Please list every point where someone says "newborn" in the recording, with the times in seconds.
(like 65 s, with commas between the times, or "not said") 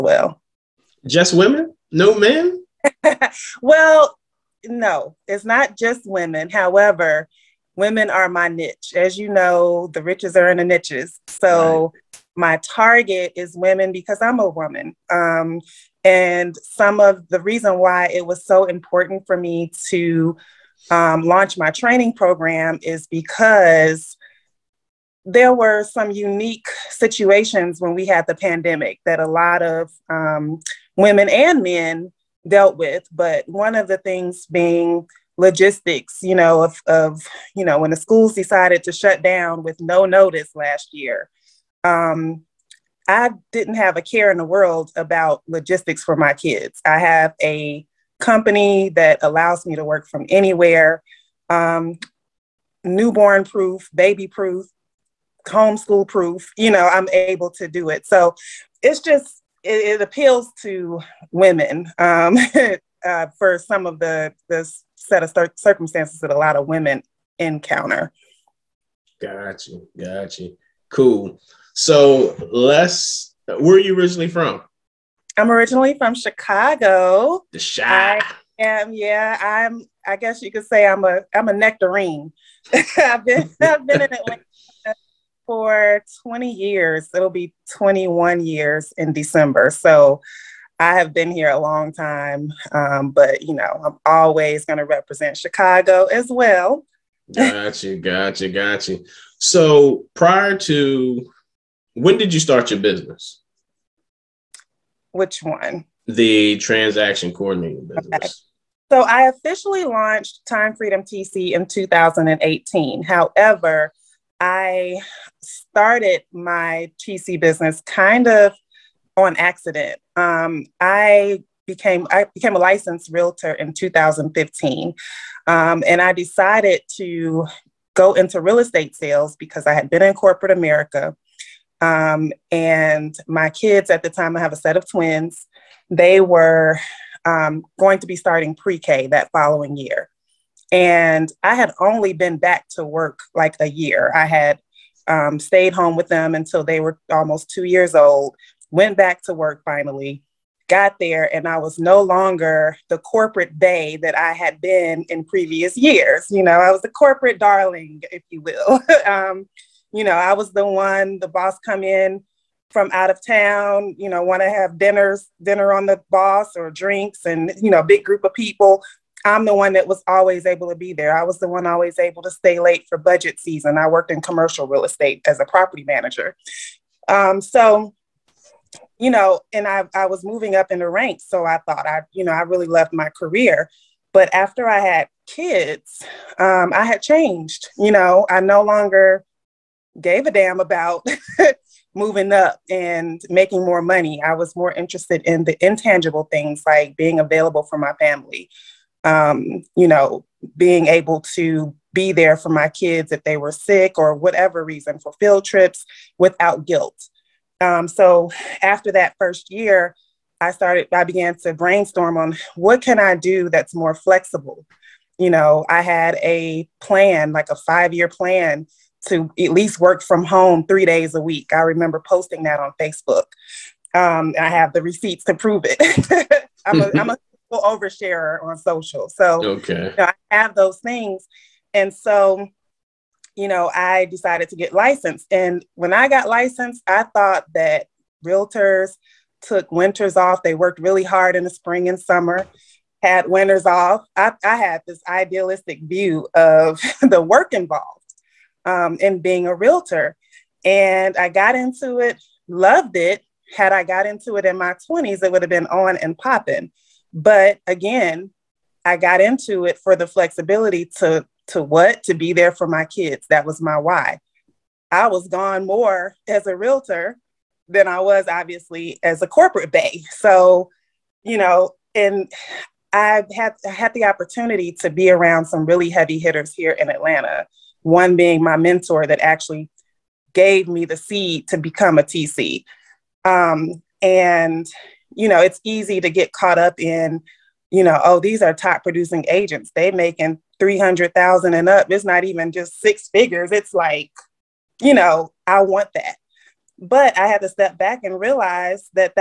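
52 s.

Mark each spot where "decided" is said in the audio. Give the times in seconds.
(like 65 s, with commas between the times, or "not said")
38 s, 126 s, 234 s.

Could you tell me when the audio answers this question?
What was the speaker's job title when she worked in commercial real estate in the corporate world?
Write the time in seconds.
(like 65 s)
175 s.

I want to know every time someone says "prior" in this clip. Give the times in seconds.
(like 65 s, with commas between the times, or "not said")
100 s.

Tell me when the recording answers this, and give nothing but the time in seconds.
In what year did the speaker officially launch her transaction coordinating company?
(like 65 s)
111 s.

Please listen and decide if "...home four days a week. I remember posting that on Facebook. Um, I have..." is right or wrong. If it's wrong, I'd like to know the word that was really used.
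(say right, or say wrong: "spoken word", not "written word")
wrong: "three", not "four".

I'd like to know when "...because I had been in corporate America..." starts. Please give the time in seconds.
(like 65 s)
129 s.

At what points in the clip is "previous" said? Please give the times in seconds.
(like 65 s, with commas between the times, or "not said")
155 s.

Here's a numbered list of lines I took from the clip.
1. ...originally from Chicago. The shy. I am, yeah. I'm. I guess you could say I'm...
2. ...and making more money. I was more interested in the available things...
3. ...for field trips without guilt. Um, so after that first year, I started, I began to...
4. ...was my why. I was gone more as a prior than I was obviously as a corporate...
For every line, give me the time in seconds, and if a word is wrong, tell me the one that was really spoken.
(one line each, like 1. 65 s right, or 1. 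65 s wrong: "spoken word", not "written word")
1. 75 s right
2. 192 s wrong: "intangible", not "available"
3. 204 s right
4. 263 s wrong: "realtor", not "prior".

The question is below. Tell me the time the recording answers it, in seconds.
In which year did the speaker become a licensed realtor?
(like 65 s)
123 s.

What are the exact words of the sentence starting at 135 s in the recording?
They were um, going to be starting pre-K that following year.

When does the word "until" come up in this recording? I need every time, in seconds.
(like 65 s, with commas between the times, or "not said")
146 s.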